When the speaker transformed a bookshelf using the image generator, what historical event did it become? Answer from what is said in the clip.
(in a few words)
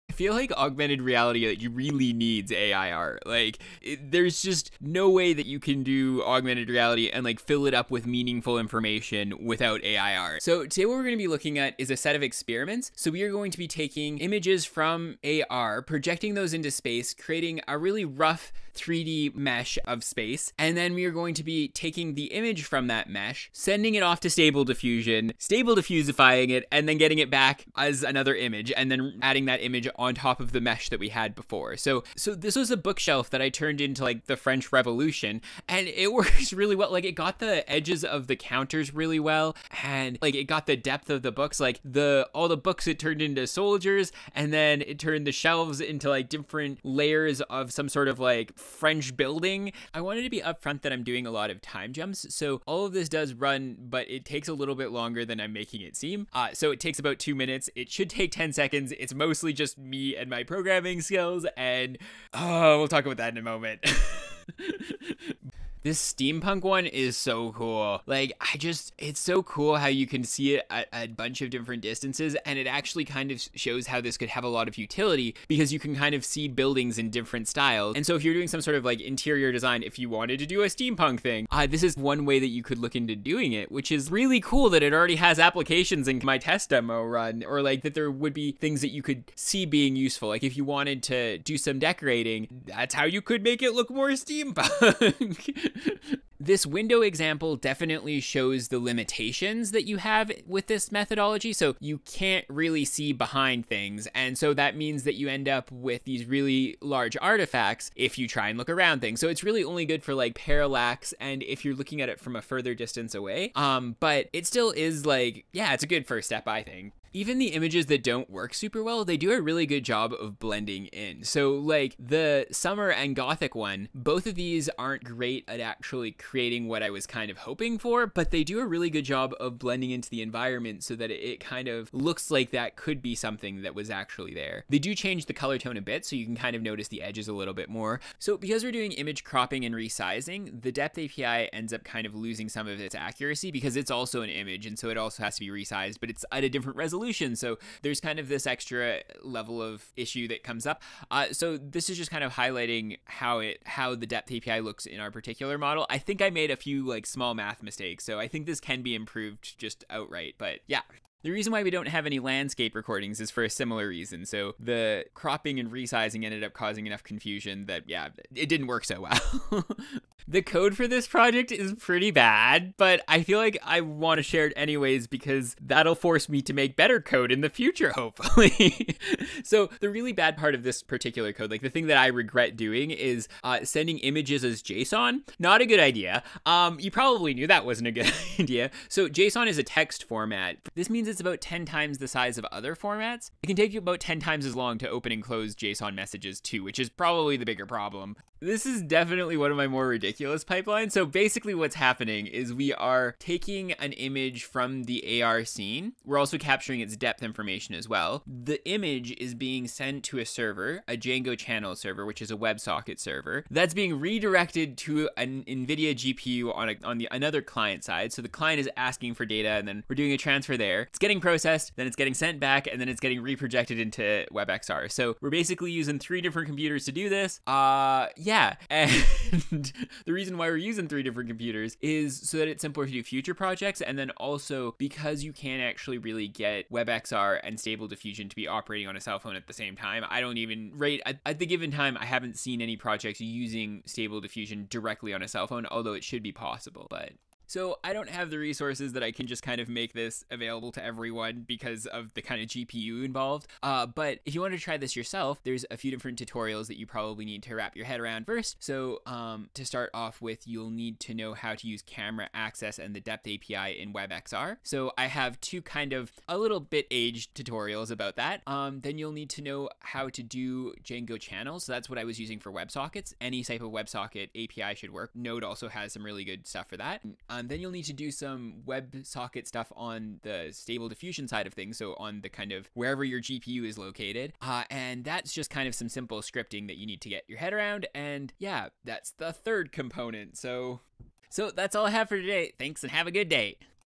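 French Revolution.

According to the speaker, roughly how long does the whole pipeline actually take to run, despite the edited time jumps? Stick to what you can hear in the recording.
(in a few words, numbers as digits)
2 minutes.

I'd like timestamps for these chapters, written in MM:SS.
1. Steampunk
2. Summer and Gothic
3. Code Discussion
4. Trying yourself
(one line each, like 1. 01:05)
1. 01:05
2. 01:59
3. 02:50
4. 04:13.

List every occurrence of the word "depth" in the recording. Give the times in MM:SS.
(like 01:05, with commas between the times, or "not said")
00:40, 02:20, 02:34, 03:26, 04:23.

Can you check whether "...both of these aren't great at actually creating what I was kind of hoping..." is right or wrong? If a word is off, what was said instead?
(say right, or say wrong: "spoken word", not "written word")
right.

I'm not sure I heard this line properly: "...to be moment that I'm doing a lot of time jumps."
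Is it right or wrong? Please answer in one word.
wrong.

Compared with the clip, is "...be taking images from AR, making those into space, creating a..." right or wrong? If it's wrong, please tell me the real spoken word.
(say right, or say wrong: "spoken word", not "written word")
wrong: "projecting", not "making".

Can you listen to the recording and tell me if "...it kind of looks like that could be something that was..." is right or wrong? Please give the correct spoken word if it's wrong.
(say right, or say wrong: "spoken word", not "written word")
right.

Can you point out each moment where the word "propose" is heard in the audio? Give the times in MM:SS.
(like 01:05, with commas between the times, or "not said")
not said.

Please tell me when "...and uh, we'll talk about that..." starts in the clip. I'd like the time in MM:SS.
01:01.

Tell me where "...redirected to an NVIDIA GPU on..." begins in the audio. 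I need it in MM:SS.
03:33.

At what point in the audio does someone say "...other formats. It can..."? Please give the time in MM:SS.
03:12.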